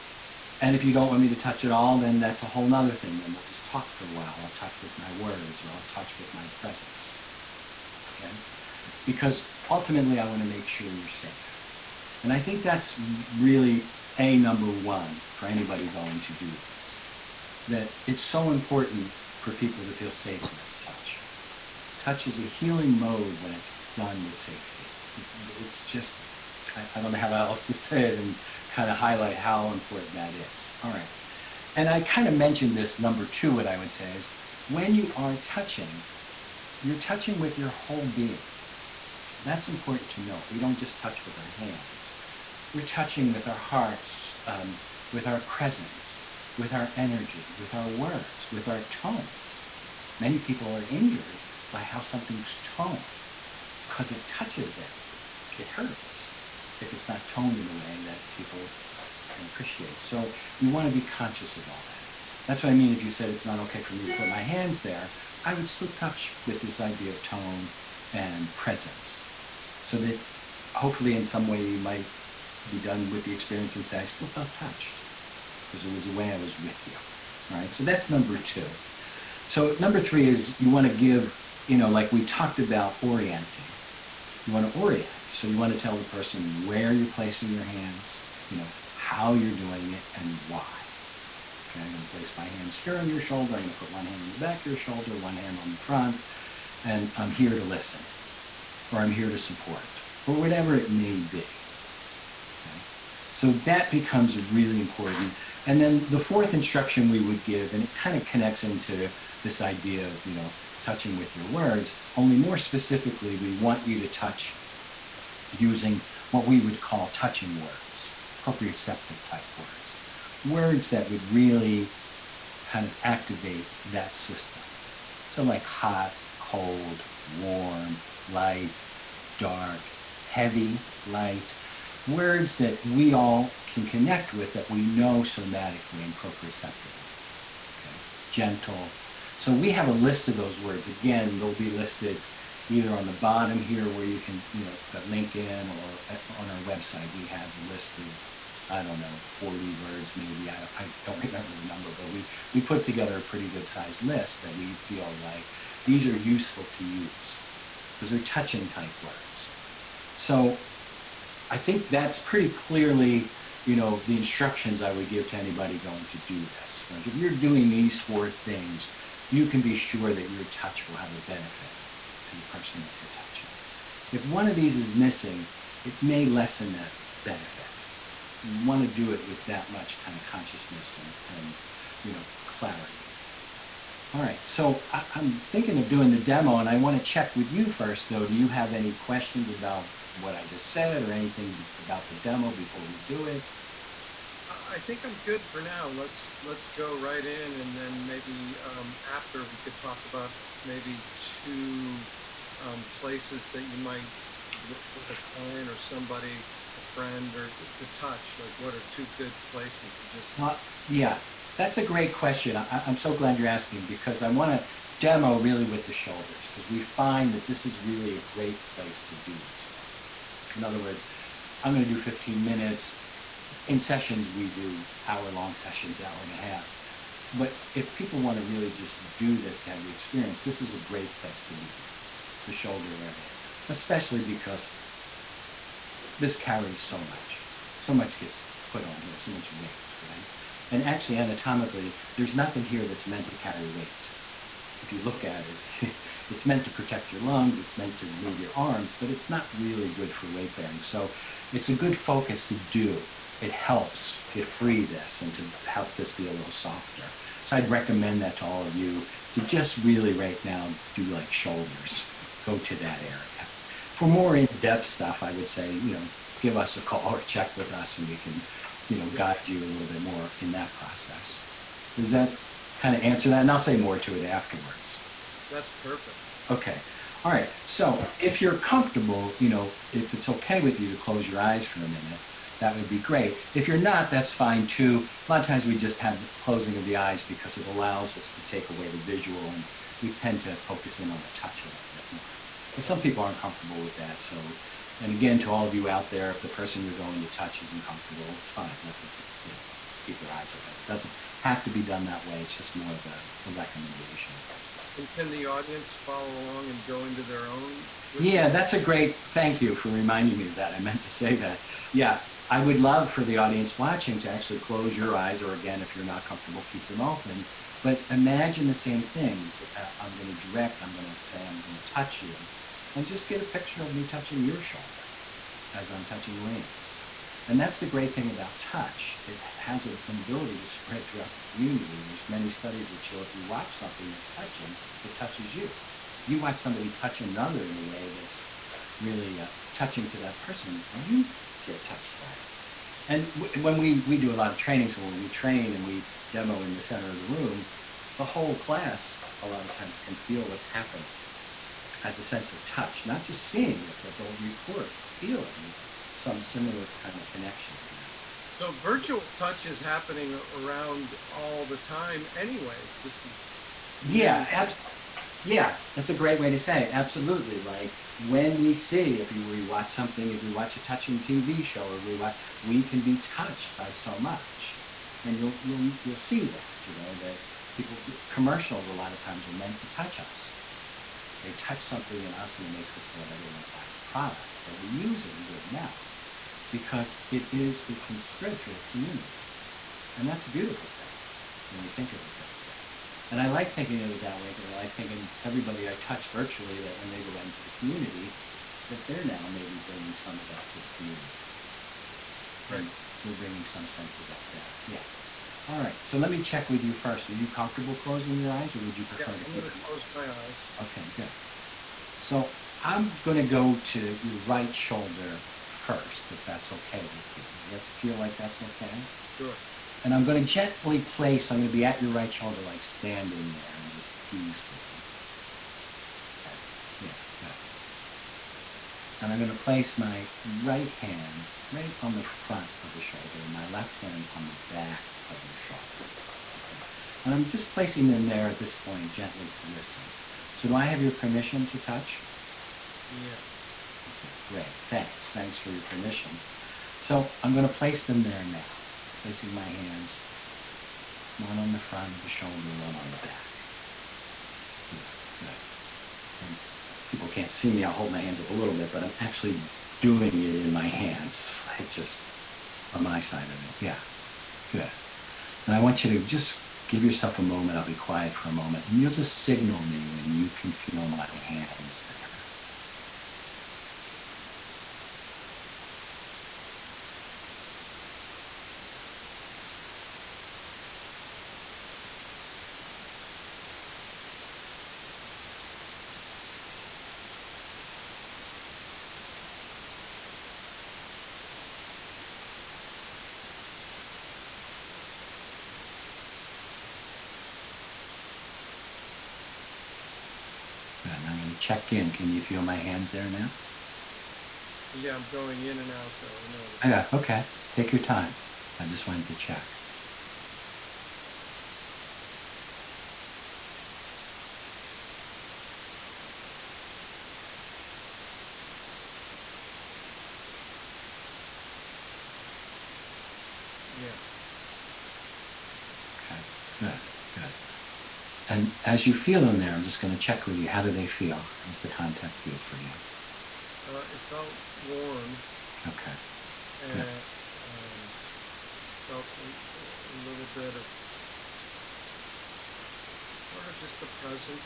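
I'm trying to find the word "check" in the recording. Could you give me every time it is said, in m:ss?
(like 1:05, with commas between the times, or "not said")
3:07, 4:27, 6:46, 8:21, 8:29, 8:50.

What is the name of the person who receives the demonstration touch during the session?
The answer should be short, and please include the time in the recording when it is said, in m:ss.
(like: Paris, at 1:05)
Liam, at 5:26.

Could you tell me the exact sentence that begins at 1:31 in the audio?
Okay, I'm going to place my hands here on your shoulder.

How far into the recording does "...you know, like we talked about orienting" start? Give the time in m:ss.
1:21.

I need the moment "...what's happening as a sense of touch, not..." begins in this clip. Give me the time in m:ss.
5:50.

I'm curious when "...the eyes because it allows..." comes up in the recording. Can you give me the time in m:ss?
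4:46.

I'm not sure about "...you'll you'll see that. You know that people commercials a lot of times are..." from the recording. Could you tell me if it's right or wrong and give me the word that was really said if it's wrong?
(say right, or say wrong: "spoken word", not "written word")
right.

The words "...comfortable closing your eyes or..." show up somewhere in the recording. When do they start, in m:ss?
6:47.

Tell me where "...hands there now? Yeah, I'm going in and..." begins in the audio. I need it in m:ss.
8:22.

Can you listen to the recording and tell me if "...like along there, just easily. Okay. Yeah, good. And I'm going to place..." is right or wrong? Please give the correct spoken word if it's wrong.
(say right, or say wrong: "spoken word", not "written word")
wrong: "standing", not "along".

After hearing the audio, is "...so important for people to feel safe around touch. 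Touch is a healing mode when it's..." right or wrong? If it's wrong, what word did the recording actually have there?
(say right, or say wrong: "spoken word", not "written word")
right.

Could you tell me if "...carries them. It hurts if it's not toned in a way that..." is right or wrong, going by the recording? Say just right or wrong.
wrong.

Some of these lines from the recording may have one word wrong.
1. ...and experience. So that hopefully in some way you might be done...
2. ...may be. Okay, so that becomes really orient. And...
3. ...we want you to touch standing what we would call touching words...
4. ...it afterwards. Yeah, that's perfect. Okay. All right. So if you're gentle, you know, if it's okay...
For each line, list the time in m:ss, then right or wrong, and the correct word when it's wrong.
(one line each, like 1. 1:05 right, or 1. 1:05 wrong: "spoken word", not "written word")
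1. 1:08 wrong: "presence", not "experience"
2. 1:40 wrong: "important", not "orient"
3. 1:53 wrong: "using", not "standing"
4. 4:34 wrong: "comfortable", not "gentle".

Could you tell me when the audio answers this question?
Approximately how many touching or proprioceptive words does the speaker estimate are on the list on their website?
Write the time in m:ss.
2:29.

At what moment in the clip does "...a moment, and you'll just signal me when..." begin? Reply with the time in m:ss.
7:48.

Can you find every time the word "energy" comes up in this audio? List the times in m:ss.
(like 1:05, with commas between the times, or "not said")
0:46.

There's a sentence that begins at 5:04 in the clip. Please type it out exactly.
And can the audience follow along and go into their own?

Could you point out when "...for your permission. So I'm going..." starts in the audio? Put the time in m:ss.
7:25.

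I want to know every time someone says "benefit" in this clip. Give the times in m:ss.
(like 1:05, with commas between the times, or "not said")
2:51, 2:57.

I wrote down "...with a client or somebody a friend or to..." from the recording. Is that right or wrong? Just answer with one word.
right.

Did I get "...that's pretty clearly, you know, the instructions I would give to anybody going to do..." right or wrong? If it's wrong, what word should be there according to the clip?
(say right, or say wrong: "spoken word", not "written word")
right.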